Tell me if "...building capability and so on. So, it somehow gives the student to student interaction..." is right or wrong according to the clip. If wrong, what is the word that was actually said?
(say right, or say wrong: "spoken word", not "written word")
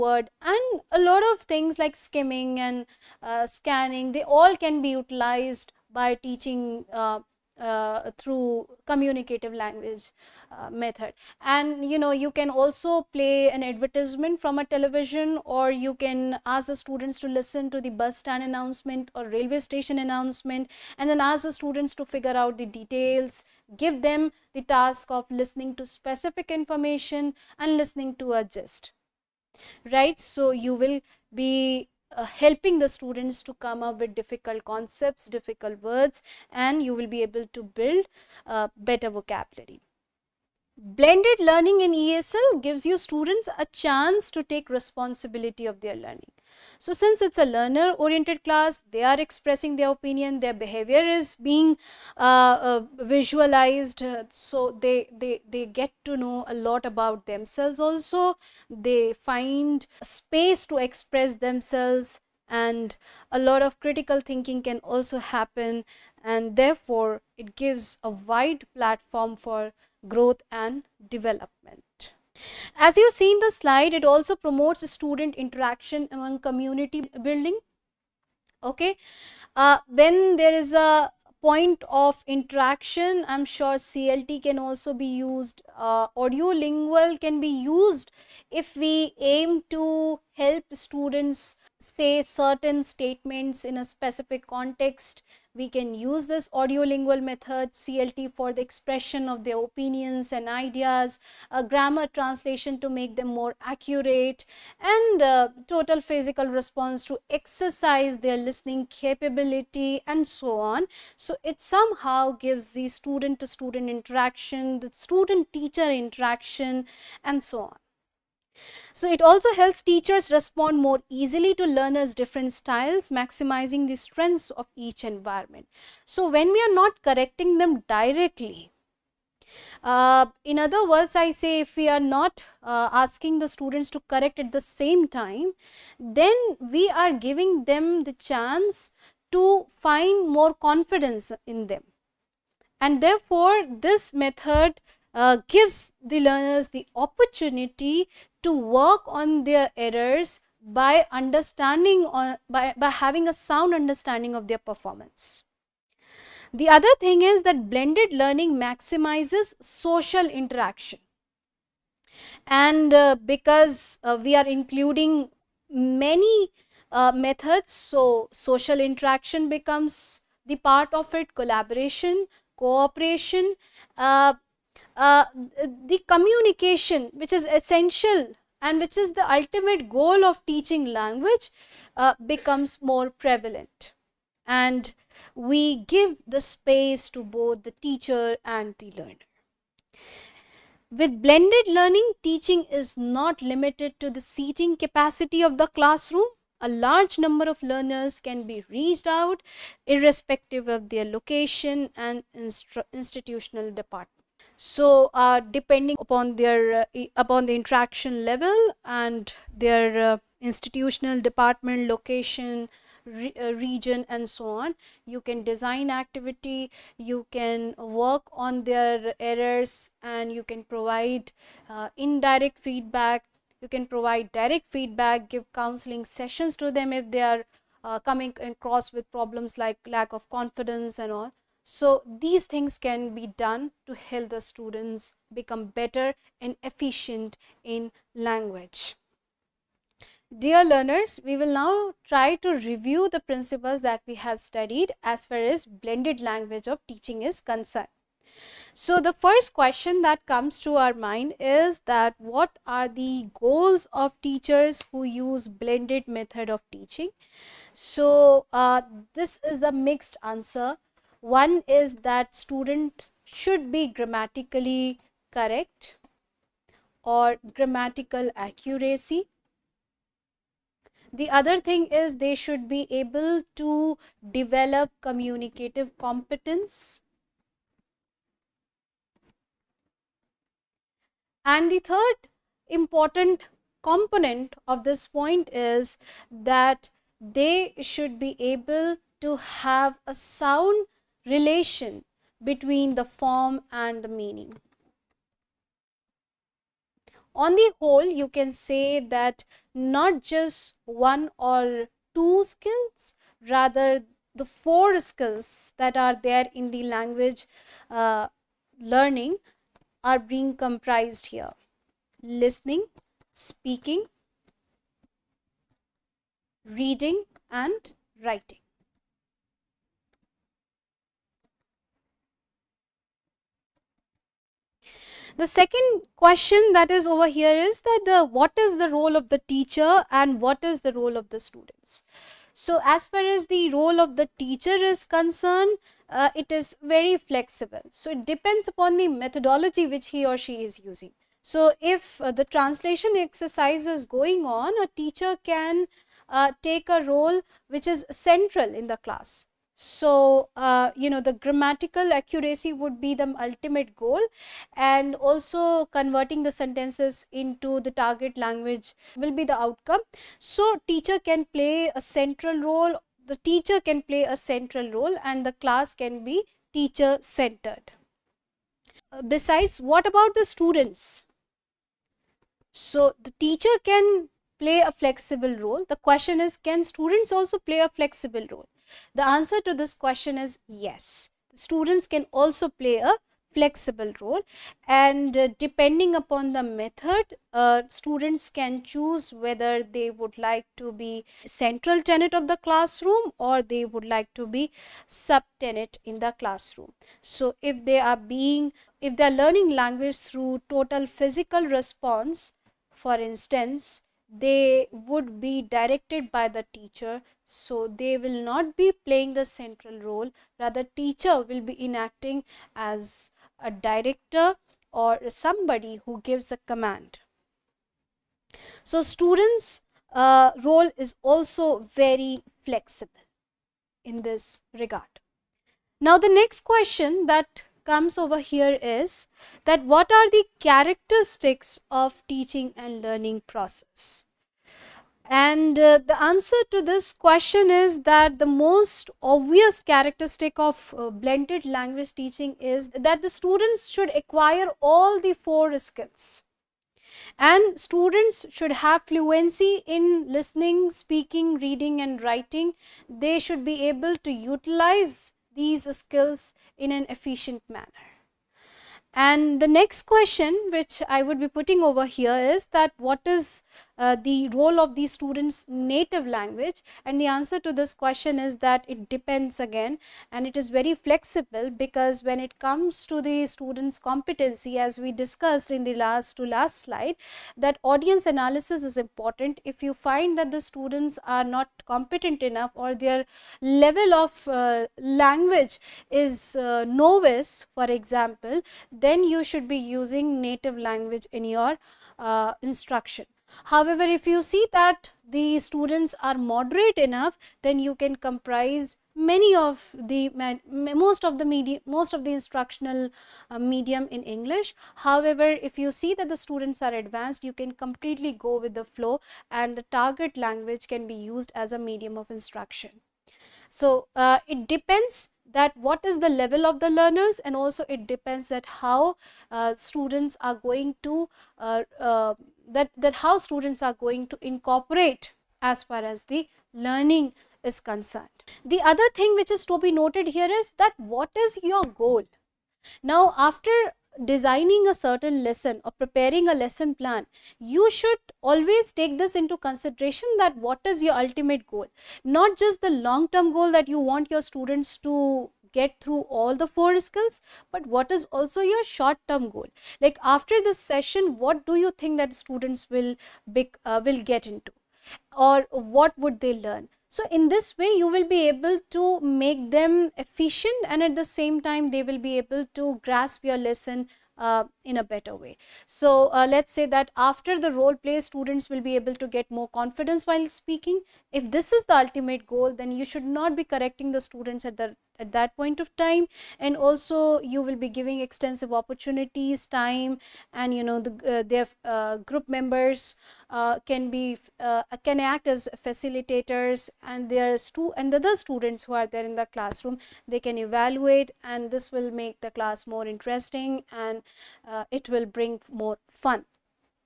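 wrong: "listening", not "building".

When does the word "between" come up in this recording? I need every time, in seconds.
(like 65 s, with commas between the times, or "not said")
292 s.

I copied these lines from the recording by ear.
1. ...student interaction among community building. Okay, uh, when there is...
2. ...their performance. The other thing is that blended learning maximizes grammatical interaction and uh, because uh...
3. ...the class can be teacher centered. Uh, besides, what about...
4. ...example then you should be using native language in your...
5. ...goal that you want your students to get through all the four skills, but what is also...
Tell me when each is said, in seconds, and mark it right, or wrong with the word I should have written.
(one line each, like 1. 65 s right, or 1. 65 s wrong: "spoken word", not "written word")
1. 74 s right
2. 154 s wrong: "social", not "grammatical"
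3. 365 s right
4. 487 s right
5. 543 s right.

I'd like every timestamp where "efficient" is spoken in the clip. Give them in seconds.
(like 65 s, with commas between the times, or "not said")
236 s, 457 s, 560 s.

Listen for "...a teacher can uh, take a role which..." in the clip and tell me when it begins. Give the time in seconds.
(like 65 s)
344 s.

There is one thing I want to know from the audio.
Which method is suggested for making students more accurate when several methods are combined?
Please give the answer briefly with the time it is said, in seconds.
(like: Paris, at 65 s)
grammar translation, at 101 s.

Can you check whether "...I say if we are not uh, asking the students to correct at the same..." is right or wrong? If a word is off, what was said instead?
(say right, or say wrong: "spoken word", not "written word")
right.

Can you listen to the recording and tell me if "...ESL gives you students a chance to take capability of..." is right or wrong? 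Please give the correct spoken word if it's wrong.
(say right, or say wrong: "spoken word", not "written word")
wrong: "responsibility", not "capability".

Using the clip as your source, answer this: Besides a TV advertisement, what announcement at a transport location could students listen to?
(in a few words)
bus stand announcement.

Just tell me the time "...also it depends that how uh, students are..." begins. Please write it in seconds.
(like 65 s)
517 s.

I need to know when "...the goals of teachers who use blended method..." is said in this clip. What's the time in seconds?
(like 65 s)
252 s.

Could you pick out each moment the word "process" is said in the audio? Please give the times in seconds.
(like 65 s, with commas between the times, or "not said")
433 s.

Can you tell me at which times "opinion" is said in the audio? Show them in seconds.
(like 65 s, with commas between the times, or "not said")
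49 s, 99 s.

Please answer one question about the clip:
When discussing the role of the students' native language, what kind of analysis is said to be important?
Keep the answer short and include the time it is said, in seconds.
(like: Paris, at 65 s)
audience analysis, at 477 s.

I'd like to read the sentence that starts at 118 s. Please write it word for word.
So it also helps teachers respond more easily to learners' different styles, maximizing the strengths of each environment.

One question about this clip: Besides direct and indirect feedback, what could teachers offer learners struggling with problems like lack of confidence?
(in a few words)
counseling sessions.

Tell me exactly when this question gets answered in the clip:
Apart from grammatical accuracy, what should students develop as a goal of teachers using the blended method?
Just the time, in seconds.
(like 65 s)
274 s.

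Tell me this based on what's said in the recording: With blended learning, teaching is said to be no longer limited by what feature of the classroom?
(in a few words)
seating capacity.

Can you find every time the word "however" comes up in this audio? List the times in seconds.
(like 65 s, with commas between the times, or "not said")
493 s, 504 s.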